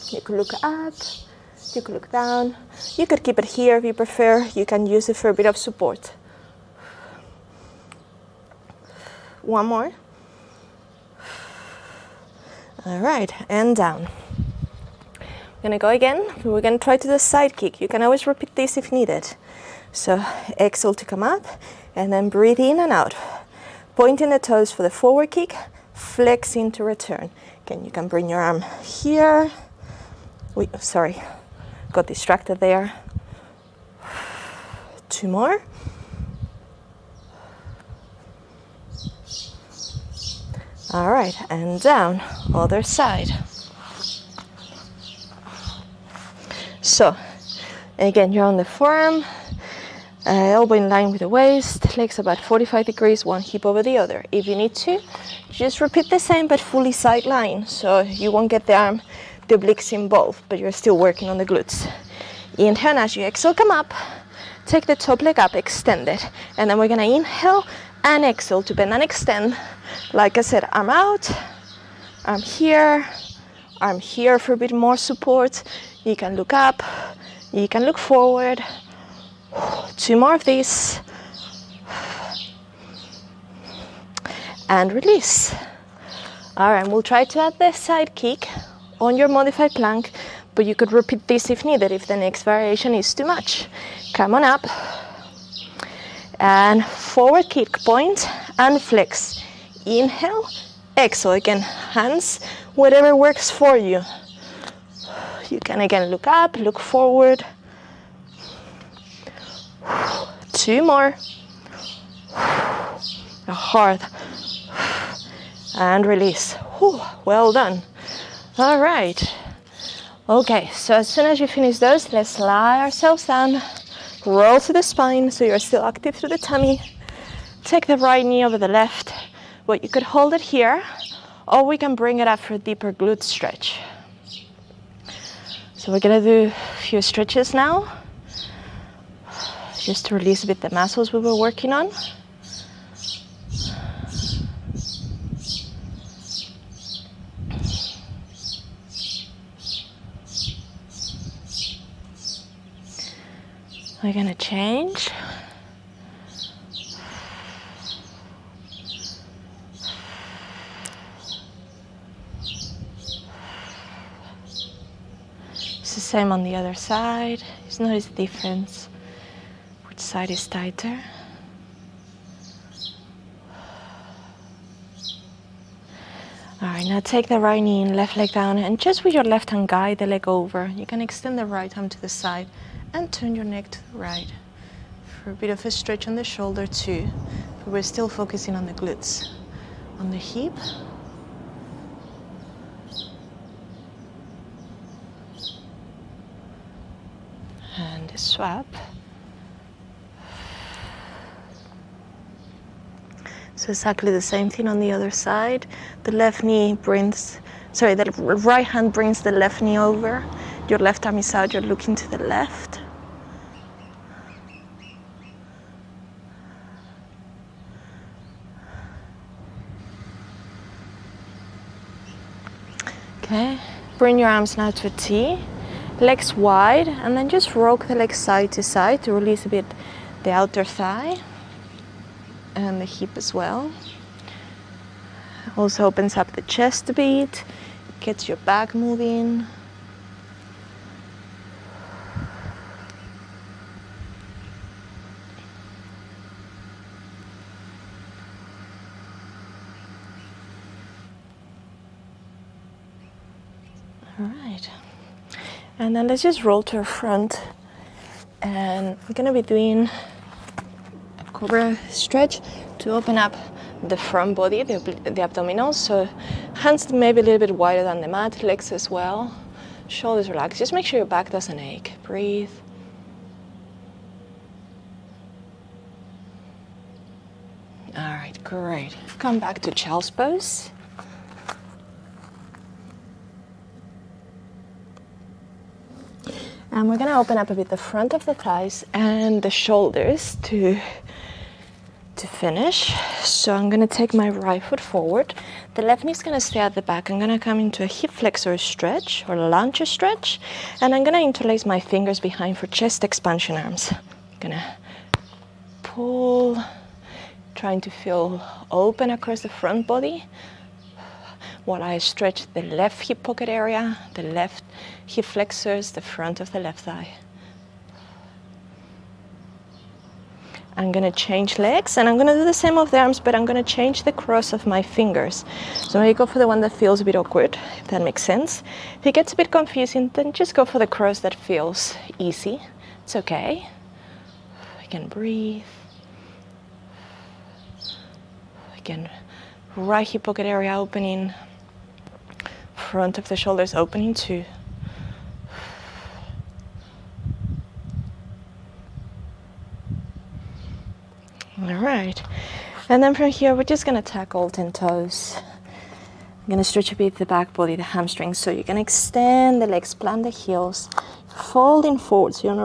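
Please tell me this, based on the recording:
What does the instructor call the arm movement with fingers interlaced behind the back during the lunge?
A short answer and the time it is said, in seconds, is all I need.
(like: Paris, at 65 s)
chest expansion, at 302 s.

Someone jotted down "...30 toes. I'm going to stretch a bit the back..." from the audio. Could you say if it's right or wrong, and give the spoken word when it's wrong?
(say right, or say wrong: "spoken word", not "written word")
wrong: "10", not "30".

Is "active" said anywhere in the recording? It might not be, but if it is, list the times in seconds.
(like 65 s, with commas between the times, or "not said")
125 s.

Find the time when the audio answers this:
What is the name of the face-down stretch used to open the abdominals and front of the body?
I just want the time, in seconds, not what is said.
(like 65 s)
261 s.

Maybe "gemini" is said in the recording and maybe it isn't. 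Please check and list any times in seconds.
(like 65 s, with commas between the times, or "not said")
not said.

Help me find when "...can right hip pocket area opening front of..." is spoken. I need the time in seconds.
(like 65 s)
339 s.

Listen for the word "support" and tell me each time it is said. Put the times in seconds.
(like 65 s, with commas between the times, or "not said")
5 s, 74 s.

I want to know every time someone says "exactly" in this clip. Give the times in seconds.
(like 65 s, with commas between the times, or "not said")
203 s.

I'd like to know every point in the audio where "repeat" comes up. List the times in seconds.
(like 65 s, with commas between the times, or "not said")
18 s, 55 s, 90 s.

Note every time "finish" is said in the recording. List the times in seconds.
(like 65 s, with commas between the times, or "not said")
121 s, 292 s.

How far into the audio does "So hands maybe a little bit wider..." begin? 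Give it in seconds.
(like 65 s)
265 s.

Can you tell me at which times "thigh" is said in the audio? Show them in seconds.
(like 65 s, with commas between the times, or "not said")
230 s, 288 s, 316 s.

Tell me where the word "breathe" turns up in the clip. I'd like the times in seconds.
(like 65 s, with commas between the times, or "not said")
22 s, 272 s, 335 s.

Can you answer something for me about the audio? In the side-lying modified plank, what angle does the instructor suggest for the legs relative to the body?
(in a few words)
45 degrees.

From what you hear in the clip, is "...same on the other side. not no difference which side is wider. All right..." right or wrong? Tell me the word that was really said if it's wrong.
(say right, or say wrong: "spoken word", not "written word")
wrong: "tighter", not "wider".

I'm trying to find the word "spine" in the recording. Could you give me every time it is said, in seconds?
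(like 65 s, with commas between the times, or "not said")
124 s.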